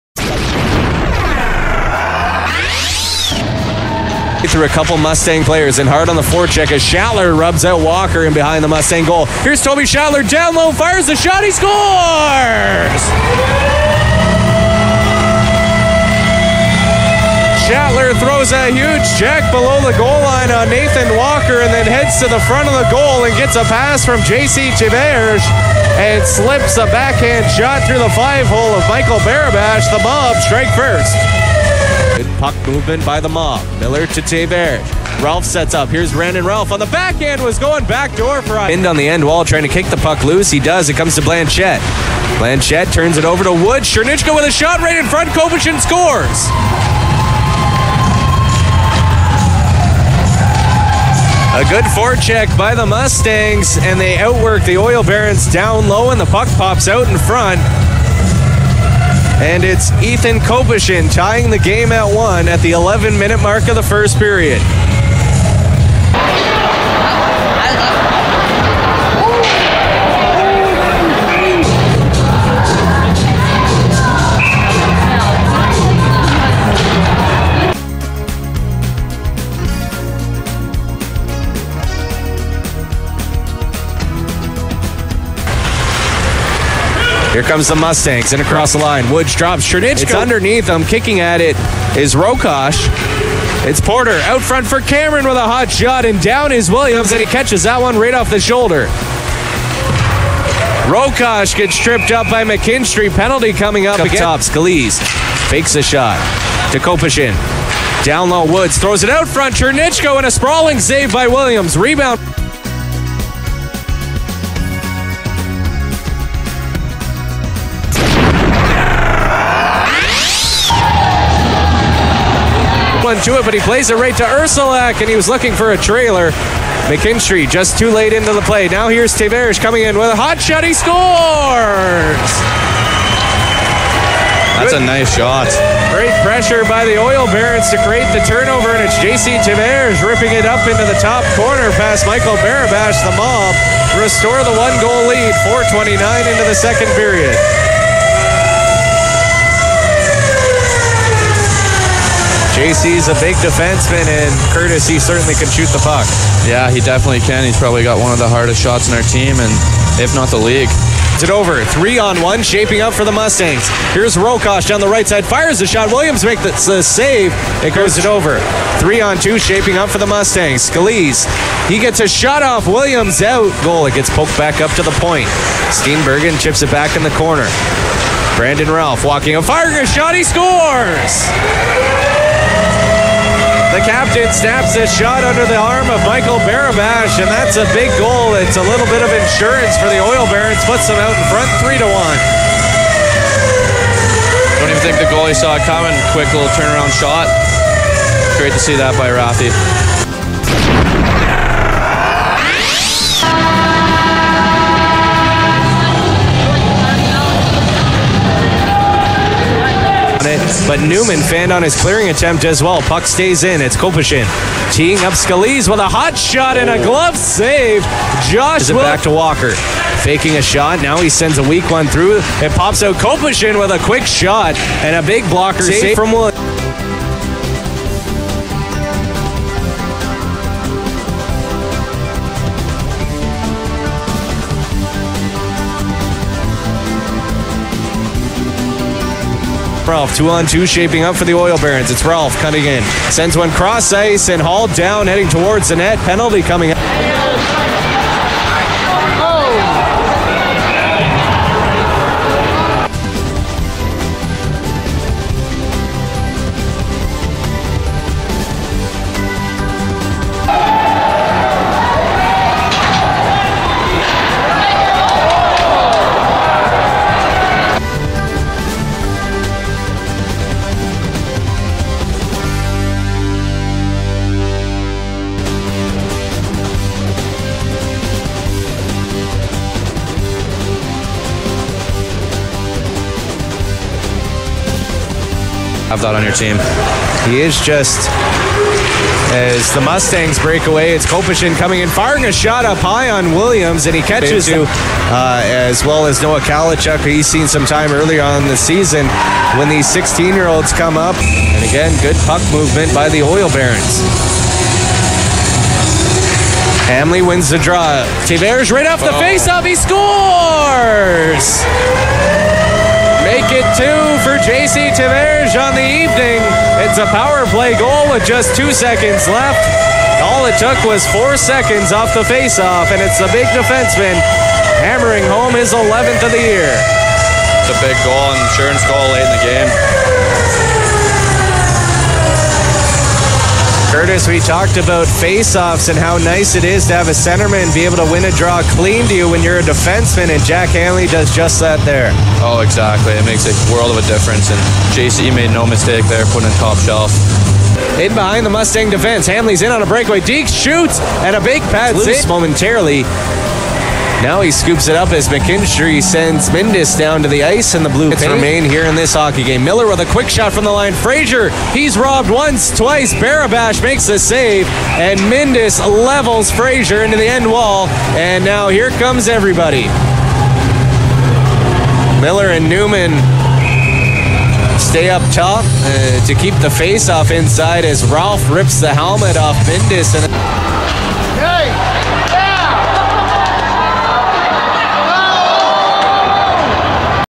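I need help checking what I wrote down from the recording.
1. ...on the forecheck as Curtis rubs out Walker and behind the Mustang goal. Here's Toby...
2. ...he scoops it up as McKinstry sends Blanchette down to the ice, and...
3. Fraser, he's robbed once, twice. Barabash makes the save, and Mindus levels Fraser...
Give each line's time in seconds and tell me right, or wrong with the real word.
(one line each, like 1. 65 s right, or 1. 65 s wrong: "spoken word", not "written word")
1. 6 s wrong: "Shattler", not "Curtis"
2. 354 s wrong: "Mindus", not "Blanchette"
3. 360 s right.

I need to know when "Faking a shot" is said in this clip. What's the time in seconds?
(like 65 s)
220 s.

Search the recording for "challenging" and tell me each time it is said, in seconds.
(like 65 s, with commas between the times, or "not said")
not said.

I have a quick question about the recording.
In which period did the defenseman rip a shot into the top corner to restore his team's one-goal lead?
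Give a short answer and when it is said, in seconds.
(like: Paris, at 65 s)
Second, at 146 s.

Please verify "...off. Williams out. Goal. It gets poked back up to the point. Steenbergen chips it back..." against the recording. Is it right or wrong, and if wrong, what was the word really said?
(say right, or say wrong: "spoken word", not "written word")
right.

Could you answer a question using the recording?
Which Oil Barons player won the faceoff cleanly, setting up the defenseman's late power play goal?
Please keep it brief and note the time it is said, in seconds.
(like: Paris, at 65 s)
Jack Hamly, at 340 s.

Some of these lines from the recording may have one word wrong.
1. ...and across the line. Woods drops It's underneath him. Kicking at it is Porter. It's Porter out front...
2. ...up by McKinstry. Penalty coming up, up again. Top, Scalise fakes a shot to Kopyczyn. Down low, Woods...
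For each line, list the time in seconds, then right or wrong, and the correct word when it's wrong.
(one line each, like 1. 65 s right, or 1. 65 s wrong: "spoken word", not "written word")
1. 88 s wrong: "Rokosh", not "Porter"
2. 102 s right.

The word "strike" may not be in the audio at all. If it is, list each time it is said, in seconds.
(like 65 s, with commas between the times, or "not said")
30 s.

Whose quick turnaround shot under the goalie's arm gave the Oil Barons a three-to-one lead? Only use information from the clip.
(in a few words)
Sargent.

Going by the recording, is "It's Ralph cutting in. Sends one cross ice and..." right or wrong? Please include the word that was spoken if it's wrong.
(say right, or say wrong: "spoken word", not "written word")
right.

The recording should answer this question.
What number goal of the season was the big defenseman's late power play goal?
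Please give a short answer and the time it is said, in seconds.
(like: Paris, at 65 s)
11, at 325 s.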